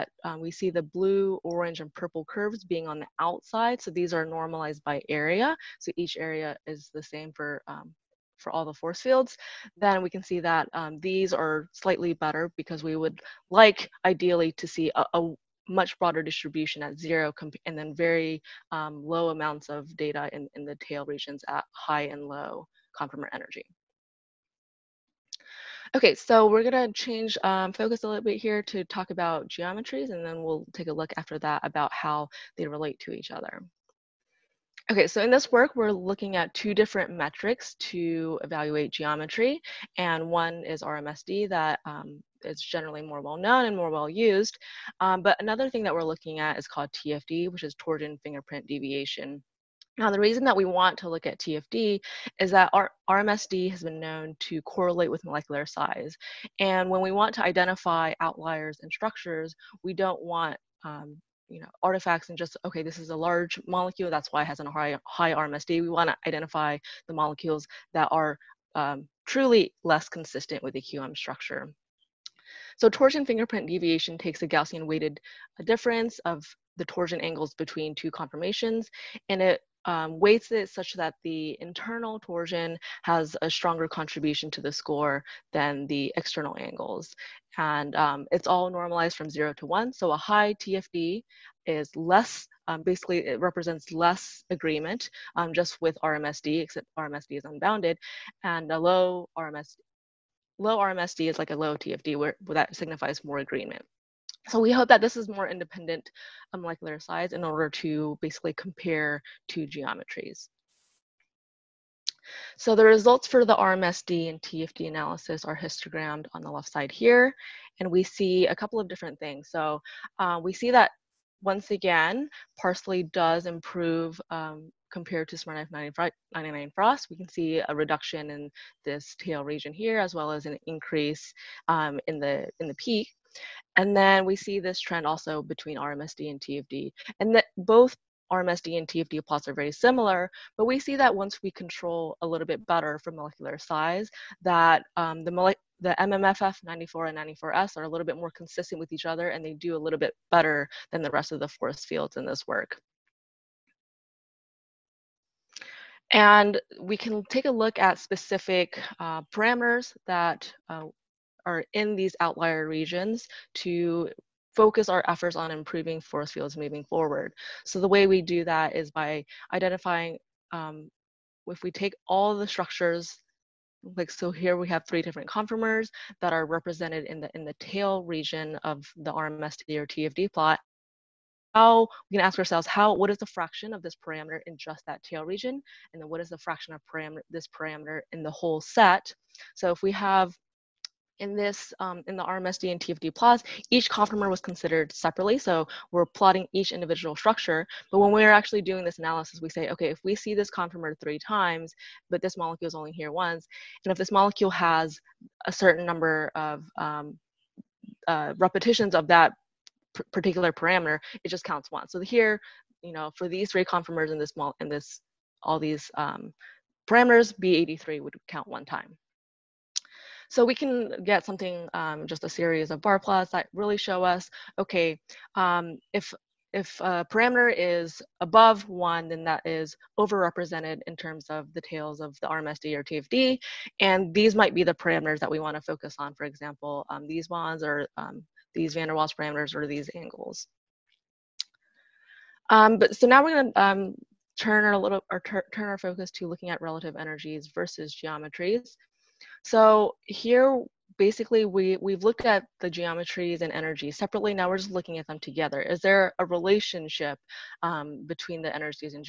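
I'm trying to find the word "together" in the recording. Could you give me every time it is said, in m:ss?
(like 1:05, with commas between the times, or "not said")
4:15.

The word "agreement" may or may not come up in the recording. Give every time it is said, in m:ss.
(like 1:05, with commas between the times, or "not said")
1:34, 1:43.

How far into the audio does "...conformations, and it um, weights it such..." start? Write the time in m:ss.
1:18.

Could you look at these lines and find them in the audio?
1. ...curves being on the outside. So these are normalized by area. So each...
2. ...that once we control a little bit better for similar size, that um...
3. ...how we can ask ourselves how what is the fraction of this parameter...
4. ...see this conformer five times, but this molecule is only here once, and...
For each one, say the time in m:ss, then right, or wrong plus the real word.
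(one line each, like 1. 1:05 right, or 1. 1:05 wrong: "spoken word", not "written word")
1. 0:02 right
2. 2:20 wrong: "molecular", not "similar"
3. 3:01 right
4. 3:20 wrong: "three", not "five".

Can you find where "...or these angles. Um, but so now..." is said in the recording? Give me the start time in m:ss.
3:59.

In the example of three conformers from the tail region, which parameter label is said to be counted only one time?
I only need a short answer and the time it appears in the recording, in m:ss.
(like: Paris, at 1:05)
B83, at 3:37.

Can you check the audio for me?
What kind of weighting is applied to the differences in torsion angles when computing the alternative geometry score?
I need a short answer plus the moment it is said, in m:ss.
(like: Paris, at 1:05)
Gaussian, at 1:14.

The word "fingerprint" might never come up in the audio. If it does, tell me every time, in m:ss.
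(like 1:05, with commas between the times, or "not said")
0:48, 1:13.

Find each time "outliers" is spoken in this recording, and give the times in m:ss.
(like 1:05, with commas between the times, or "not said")
0:58, 2:42.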